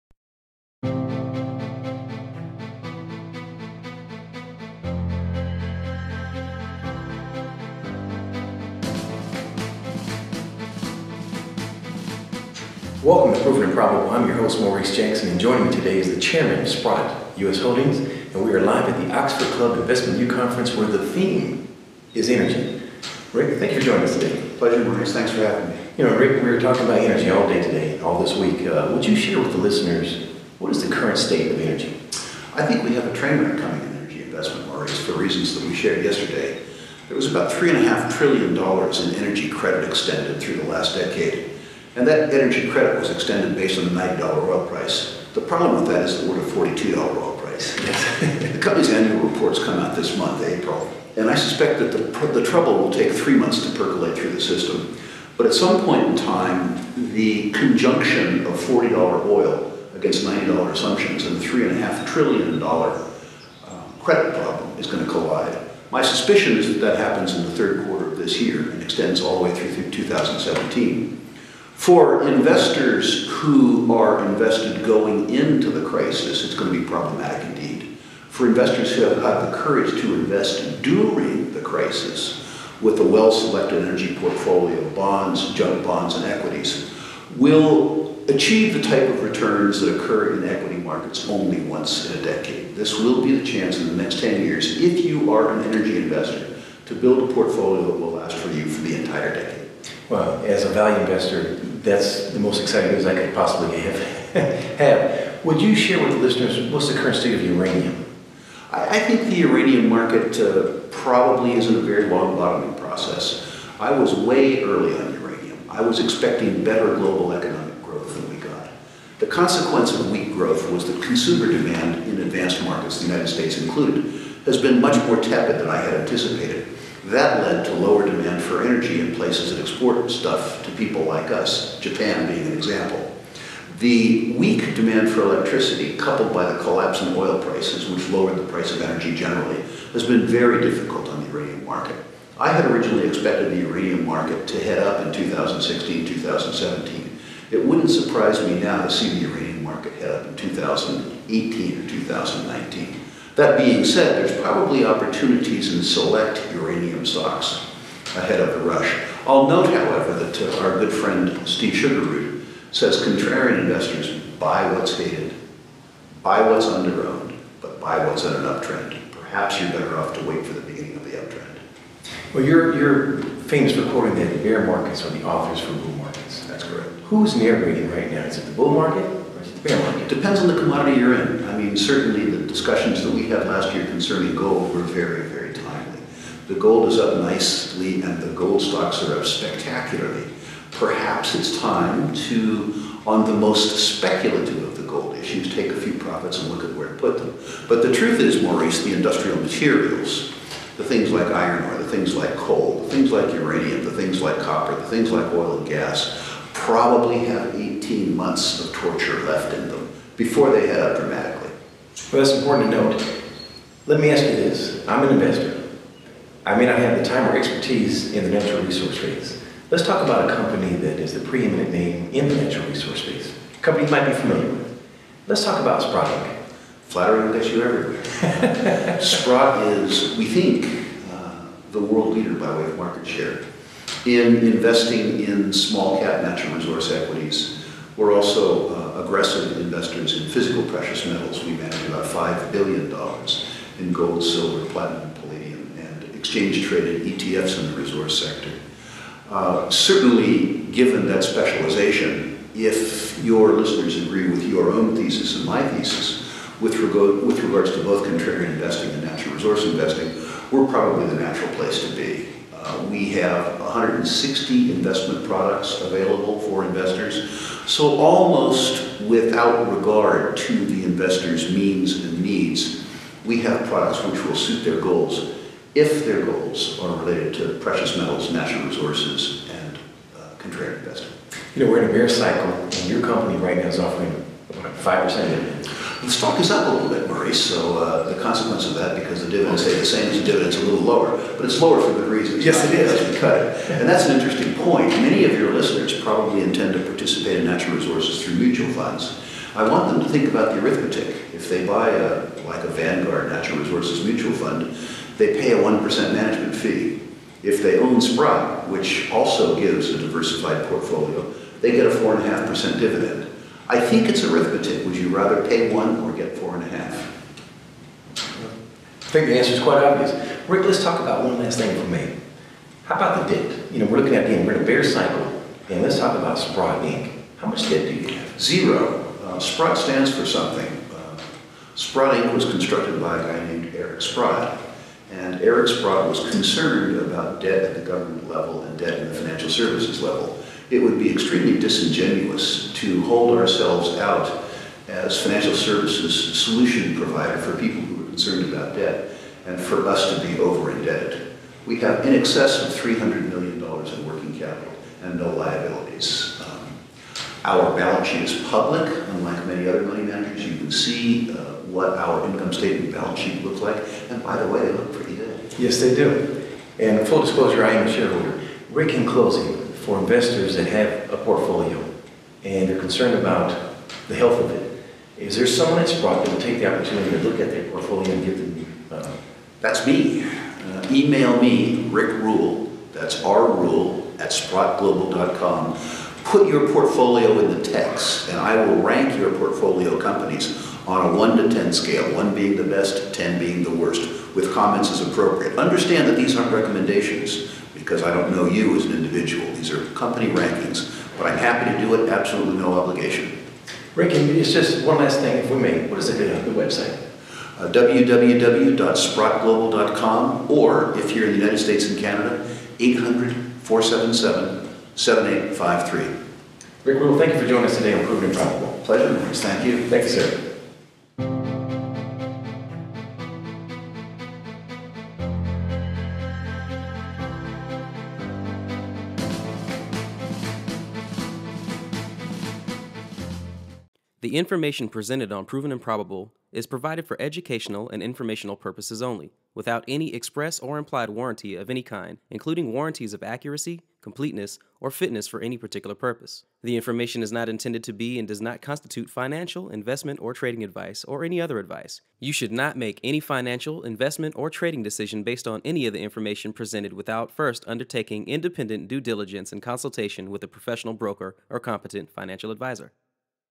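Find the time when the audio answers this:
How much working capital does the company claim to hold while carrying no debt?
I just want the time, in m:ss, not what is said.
5:52.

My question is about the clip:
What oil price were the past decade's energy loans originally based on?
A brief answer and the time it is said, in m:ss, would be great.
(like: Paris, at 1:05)
$90, at 0:43.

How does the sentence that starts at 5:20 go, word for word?
Rick, let's talk about one last thing for me.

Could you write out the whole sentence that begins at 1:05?
My suspicion is that that happens in the third quarter of this year and extends all the way through 2017.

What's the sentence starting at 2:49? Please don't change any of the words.
Perhaps you're better off to wait for the beginning of the uptrend.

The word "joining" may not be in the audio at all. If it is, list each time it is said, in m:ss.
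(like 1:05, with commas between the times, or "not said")
0:15, 0:23, 6:57.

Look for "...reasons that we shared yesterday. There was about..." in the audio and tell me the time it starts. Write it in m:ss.
0:35.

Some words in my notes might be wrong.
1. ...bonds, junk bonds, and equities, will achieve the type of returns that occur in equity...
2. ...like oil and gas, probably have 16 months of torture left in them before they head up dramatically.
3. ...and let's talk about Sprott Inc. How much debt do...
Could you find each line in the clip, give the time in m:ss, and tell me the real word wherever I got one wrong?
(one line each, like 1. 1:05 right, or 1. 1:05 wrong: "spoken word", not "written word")
1. 1:24 right
2. 3:25 wrong: "18", not "16"
3. 5:25 right.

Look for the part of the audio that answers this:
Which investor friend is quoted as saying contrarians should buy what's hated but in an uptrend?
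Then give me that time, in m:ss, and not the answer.
2:41.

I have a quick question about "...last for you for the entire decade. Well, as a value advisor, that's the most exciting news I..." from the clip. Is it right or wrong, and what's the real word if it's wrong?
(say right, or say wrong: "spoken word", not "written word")
wrong: "investor", not "advisor".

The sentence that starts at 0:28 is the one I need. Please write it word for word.
Uh, would you share with the listeners what is the current state of energy?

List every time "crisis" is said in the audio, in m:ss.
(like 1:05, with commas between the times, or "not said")
1:15, 1:21.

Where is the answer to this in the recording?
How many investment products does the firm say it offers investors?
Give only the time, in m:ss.
4:23.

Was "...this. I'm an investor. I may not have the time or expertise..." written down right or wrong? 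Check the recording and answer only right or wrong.
right.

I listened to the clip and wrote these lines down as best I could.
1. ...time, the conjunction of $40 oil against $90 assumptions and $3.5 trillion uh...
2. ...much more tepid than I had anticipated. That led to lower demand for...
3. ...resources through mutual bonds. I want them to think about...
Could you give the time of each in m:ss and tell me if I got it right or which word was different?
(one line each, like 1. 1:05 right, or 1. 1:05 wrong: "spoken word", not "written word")
1. 0:56 right
2. 2:04 right
3. 4:57 wrong: "funds", not "bonds".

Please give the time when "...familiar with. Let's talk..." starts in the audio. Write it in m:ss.
3:44.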